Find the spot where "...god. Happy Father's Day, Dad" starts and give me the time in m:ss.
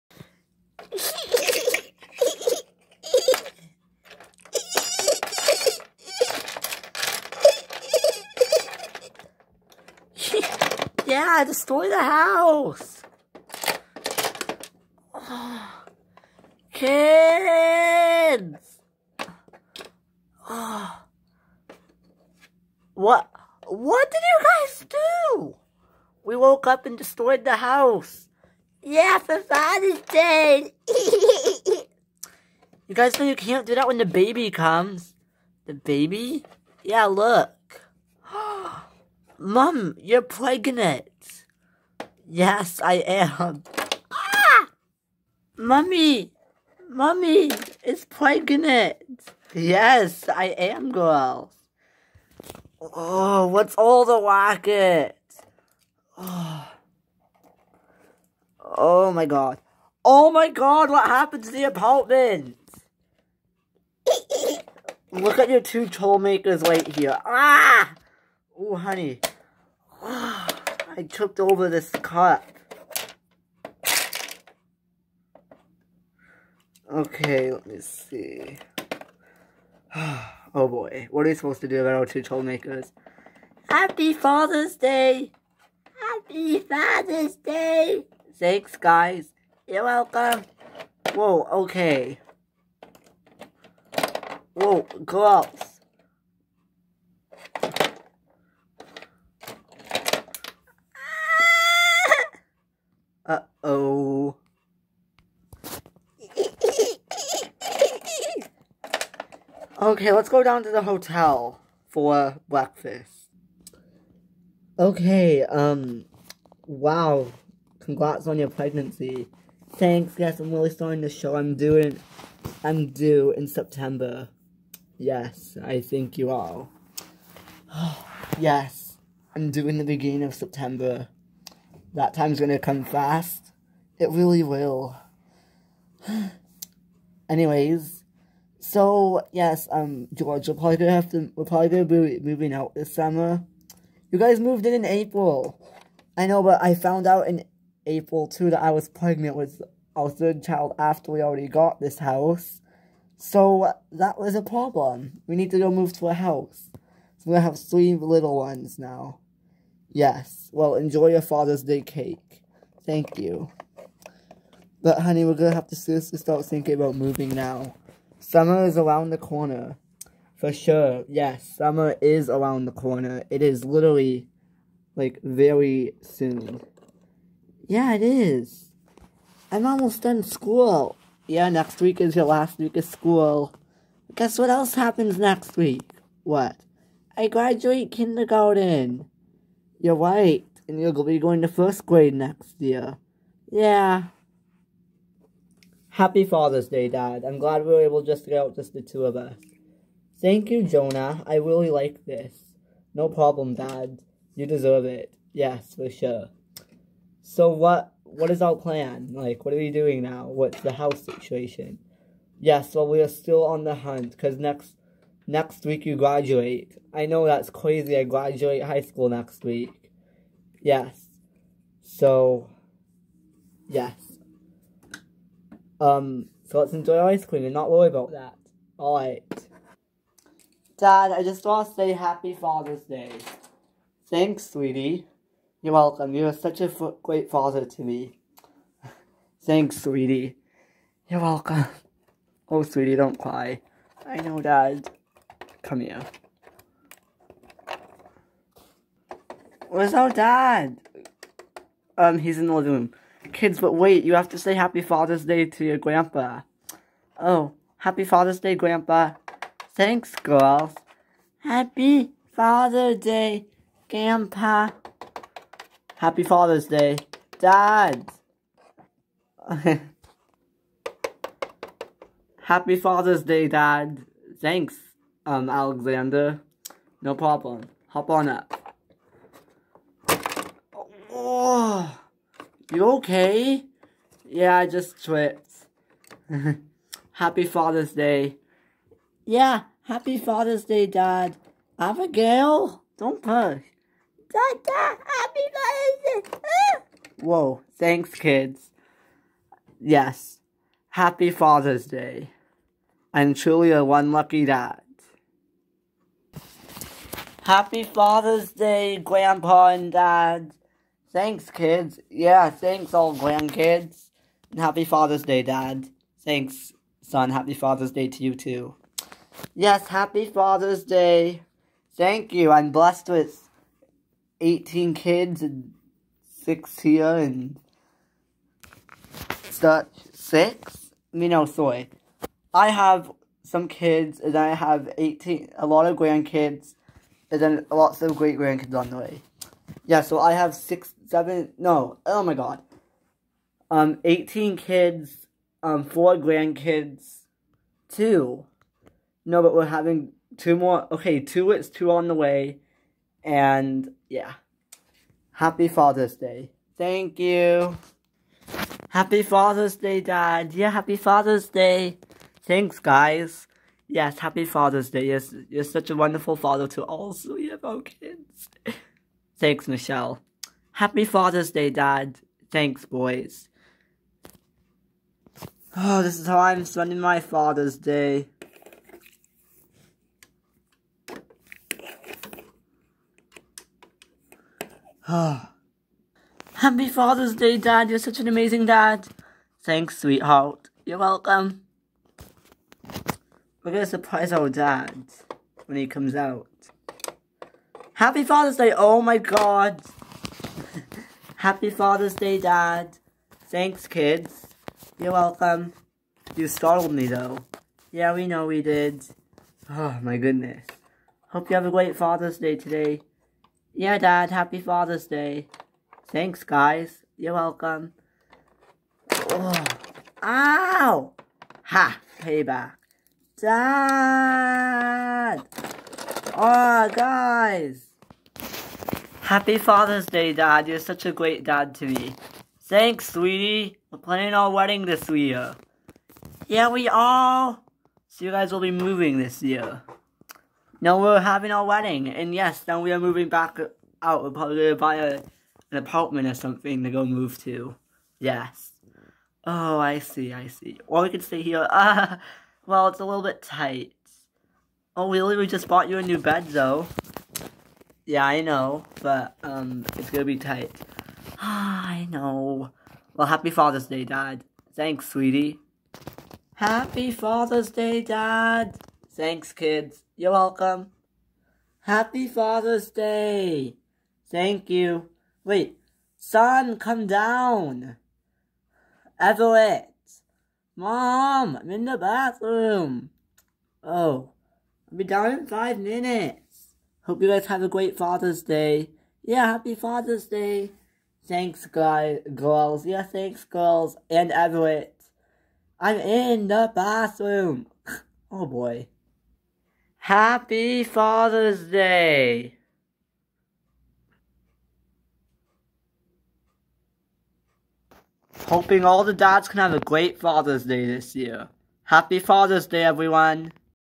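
6:39.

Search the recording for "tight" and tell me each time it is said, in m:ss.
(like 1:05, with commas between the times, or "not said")
7:33, 7:40.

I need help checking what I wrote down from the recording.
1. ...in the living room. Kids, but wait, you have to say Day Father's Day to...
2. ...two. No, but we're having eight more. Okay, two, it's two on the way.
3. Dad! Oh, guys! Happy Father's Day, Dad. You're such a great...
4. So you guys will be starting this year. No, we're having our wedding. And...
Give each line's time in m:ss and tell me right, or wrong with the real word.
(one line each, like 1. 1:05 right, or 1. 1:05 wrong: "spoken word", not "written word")
1. 4:12 wrong: "Happy", not "Day"
2. 5:47 wrong: "two", not "eight"
3. 7:03 right
4. 7:18 wrong: "moving", not "starting".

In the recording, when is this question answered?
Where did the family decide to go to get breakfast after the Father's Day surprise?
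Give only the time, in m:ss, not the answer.
1:50.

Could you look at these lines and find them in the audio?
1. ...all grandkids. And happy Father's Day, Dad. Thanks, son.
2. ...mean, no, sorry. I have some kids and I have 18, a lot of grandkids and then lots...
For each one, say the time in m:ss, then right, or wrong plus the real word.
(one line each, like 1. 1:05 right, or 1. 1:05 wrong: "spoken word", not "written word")
1. 5:12 right
2. 5:31 right.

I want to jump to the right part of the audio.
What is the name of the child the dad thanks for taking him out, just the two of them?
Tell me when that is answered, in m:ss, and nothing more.
3:20.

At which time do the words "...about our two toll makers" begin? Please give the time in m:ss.
1:21.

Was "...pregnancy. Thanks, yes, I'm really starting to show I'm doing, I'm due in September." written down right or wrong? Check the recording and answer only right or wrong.
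right.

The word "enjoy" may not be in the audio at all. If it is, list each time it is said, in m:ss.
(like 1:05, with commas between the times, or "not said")
2:40, 3:46.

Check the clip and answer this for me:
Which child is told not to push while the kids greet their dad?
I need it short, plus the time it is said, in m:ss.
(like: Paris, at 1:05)
Abigail, at 4:51.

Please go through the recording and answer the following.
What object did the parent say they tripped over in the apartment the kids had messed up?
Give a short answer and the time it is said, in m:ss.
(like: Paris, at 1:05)
cup, at 1:11.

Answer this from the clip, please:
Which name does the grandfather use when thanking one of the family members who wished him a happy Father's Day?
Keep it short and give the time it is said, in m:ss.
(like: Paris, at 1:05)
Alexander, at 4:35.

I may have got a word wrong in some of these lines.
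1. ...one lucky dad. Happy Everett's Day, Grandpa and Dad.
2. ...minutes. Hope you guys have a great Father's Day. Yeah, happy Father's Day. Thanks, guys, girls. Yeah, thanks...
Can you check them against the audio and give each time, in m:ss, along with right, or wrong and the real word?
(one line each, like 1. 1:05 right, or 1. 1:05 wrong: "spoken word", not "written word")
1. 5:03 wrong: "Father", not "Everett"
2. 8:05 right.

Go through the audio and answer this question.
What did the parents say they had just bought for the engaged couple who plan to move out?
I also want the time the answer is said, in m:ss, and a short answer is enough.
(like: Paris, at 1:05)
a new bed, at 7:35.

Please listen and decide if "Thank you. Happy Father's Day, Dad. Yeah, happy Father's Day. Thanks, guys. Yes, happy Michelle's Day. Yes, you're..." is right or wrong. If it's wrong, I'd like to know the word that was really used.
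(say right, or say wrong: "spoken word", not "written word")
wrong: "Father", not "Michelle".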